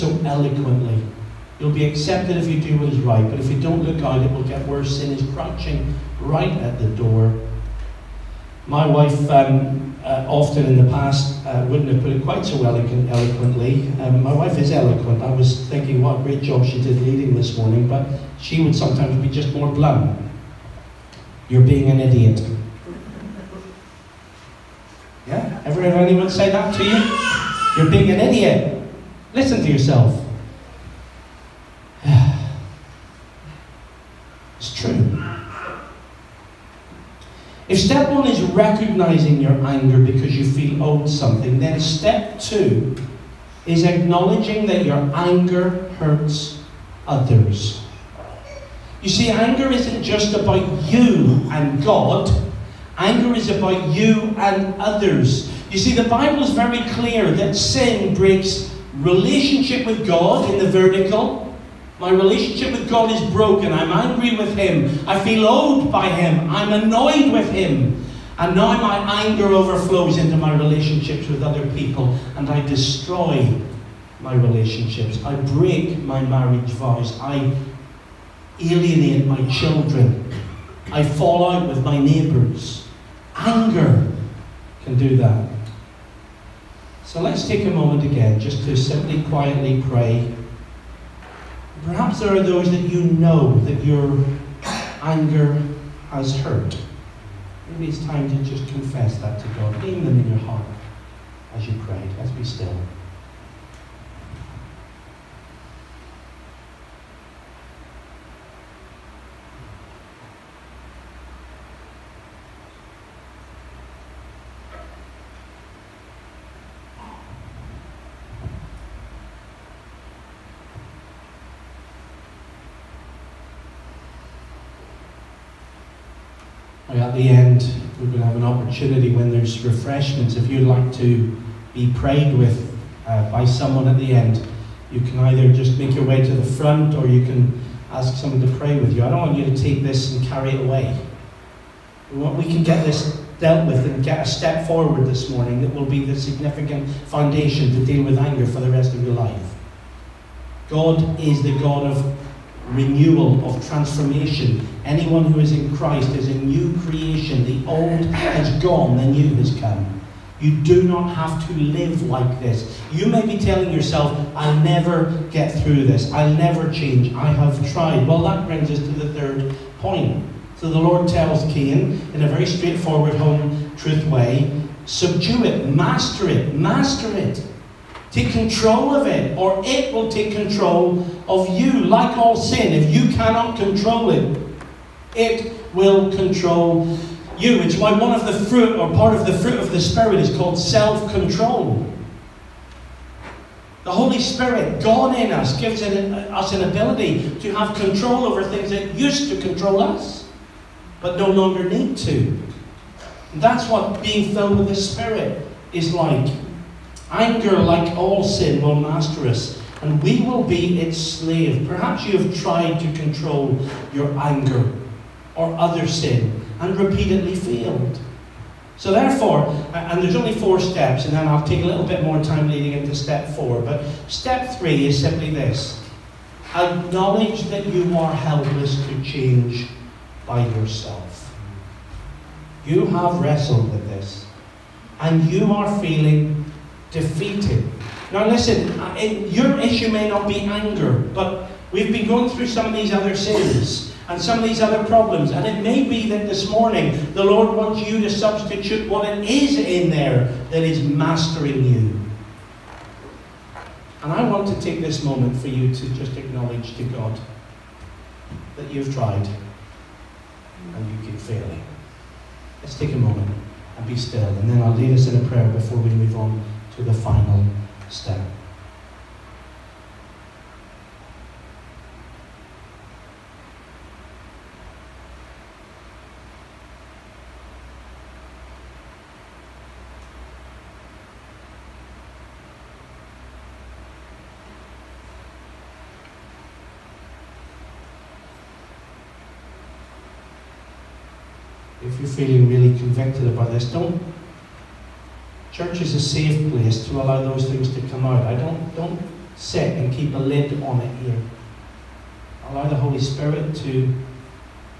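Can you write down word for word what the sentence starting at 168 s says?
Well, that brings us to the third point.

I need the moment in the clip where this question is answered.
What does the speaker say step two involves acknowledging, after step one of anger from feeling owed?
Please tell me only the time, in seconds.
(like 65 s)
44 s.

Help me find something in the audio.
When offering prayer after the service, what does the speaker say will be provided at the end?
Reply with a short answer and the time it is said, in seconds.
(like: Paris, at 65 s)
Refreshments, at 129 s.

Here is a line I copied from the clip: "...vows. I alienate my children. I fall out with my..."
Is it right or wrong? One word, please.
right.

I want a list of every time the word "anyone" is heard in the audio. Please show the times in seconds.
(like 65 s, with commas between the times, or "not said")
25 s, 154 s.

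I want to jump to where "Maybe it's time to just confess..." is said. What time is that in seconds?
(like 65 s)
97 s.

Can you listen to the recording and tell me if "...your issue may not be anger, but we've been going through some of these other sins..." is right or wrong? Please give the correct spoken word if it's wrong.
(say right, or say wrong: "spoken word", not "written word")
right.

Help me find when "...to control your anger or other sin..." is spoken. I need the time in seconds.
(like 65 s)
212 s.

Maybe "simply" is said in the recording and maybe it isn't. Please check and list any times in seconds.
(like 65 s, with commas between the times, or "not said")
88 s, 224 s.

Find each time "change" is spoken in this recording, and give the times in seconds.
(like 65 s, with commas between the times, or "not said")
166 s, 229 s.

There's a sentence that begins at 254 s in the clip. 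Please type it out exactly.
And I want to take this moment for you to just acknowledge to God that you've tried and you keep failing.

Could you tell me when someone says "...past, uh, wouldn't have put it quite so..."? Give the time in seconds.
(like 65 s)
10 s.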